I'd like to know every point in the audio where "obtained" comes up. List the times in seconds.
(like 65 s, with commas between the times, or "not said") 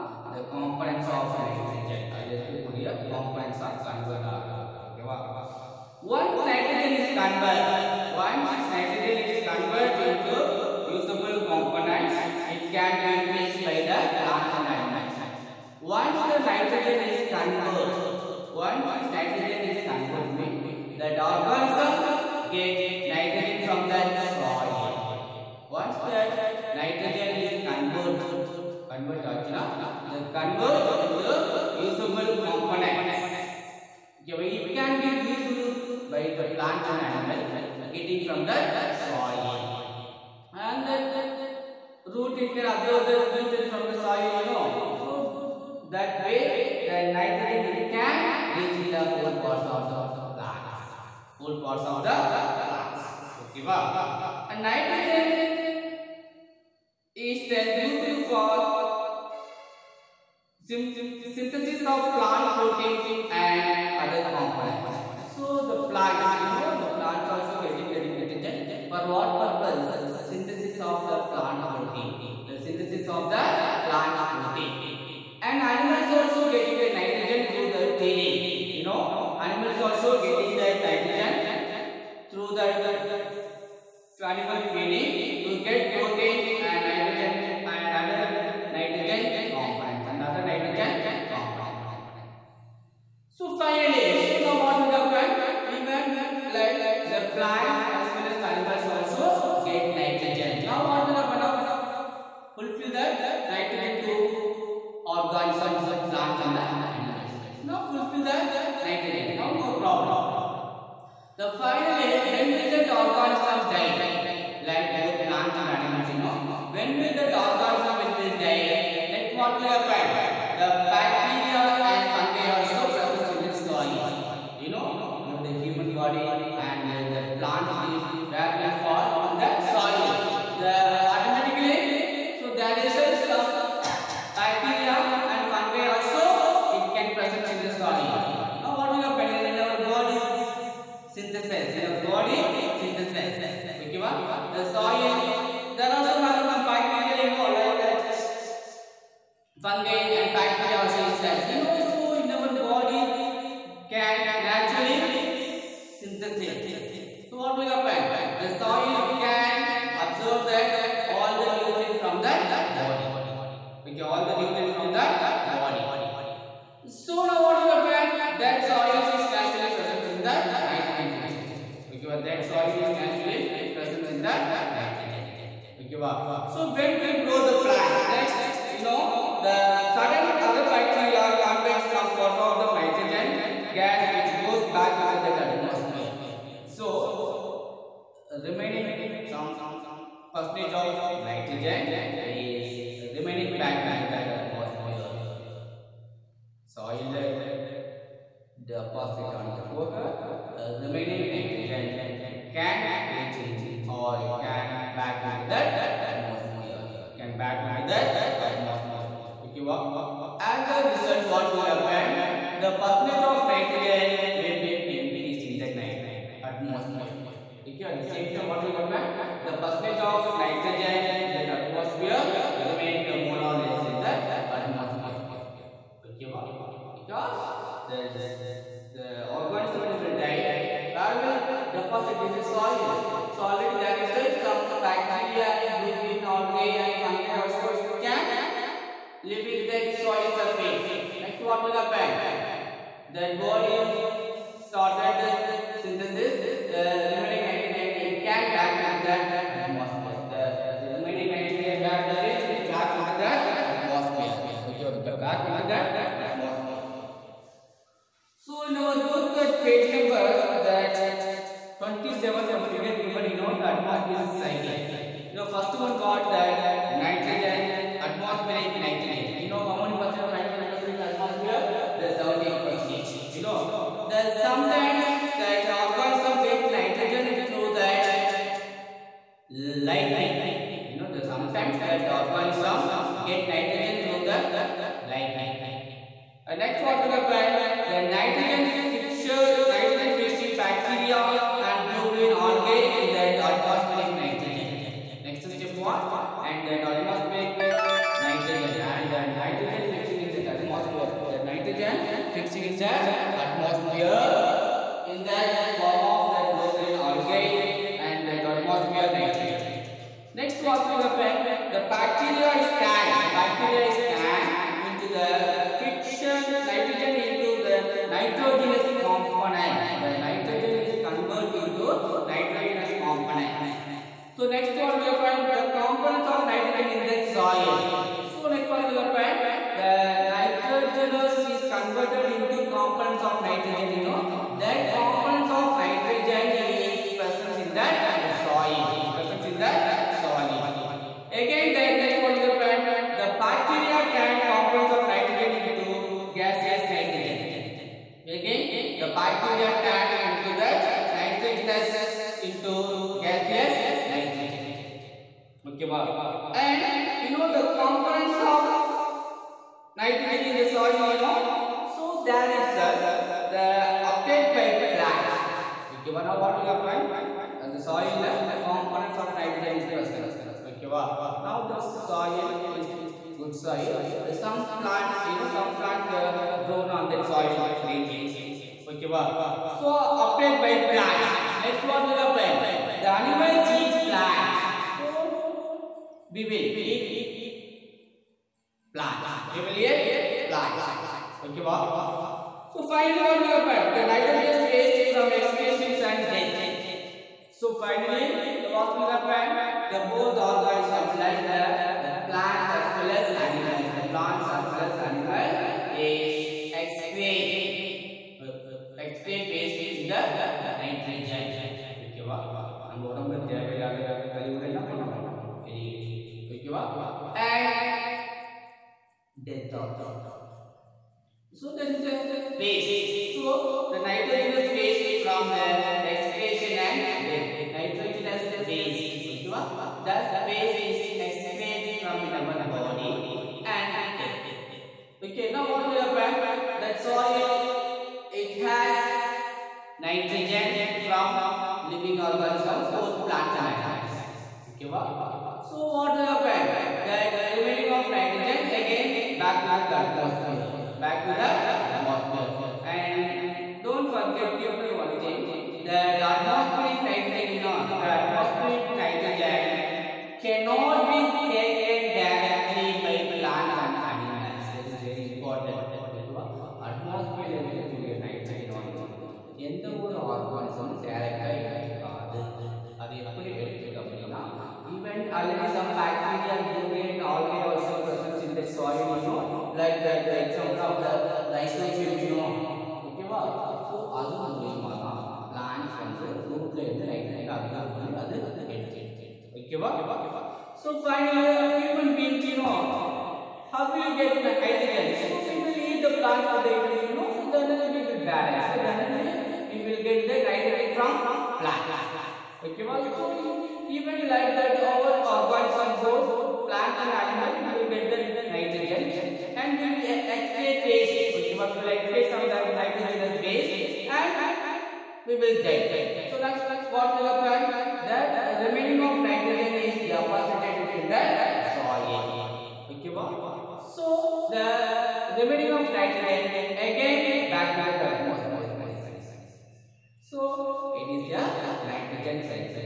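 364 s, 379 s.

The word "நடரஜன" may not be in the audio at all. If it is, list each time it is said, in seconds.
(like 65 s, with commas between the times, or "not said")
2 s, 468 s, 487 s.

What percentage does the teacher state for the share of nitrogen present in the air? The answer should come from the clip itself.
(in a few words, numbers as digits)
17 percent.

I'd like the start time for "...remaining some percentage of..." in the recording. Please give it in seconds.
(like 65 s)
188 s.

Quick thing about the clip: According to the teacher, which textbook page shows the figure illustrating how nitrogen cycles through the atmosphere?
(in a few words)
27.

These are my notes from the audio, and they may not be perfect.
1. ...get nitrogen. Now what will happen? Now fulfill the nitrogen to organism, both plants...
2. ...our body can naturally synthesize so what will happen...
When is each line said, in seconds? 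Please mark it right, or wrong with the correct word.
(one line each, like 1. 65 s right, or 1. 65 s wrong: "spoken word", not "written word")
1. 99 s right
2. 152 s right.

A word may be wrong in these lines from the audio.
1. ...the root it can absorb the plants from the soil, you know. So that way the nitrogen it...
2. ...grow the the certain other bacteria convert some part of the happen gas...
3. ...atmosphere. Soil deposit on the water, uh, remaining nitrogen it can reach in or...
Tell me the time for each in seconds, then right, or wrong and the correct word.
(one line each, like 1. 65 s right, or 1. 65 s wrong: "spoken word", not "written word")
1. 40 s wrong: "nutrients", not "plants"
2. 177 s wrong: "nitrogen", not "happen"
3. 194 s right.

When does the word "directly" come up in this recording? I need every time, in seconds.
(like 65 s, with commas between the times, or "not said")
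462 s.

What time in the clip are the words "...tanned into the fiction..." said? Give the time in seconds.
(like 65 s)
314 s.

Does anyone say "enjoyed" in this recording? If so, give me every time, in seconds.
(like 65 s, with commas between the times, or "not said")
not said.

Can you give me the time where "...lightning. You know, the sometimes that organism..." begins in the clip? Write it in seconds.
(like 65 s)
279 s.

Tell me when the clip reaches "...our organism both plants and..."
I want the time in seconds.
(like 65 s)
504 s.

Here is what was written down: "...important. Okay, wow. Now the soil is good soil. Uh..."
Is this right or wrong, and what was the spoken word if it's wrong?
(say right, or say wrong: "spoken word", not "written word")
wrong: "present", not "important".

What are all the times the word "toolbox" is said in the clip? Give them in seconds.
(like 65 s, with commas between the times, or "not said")
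not said.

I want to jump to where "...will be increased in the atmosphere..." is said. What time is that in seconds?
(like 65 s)
214 s.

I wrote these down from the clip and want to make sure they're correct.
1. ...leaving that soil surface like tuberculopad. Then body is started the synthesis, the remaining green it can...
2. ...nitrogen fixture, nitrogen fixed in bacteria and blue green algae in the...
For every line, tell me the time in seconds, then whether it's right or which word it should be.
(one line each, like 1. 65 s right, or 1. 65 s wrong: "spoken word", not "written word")
1. 239 s wrong: "nitrogen", not "green"
2. 288 s right.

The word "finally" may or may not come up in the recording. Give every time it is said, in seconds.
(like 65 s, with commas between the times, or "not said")
93 s, 111 s, 392 s, 397 s, 491 s.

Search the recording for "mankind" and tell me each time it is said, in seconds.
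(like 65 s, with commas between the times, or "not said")
not said.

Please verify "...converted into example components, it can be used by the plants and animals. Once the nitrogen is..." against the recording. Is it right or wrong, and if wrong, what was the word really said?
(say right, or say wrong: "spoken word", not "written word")
wrong: "usable", not "example".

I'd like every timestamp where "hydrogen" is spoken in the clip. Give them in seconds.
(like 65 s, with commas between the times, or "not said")
494 s.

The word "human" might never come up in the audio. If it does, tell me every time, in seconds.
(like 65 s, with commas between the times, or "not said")
125 s, 491 s.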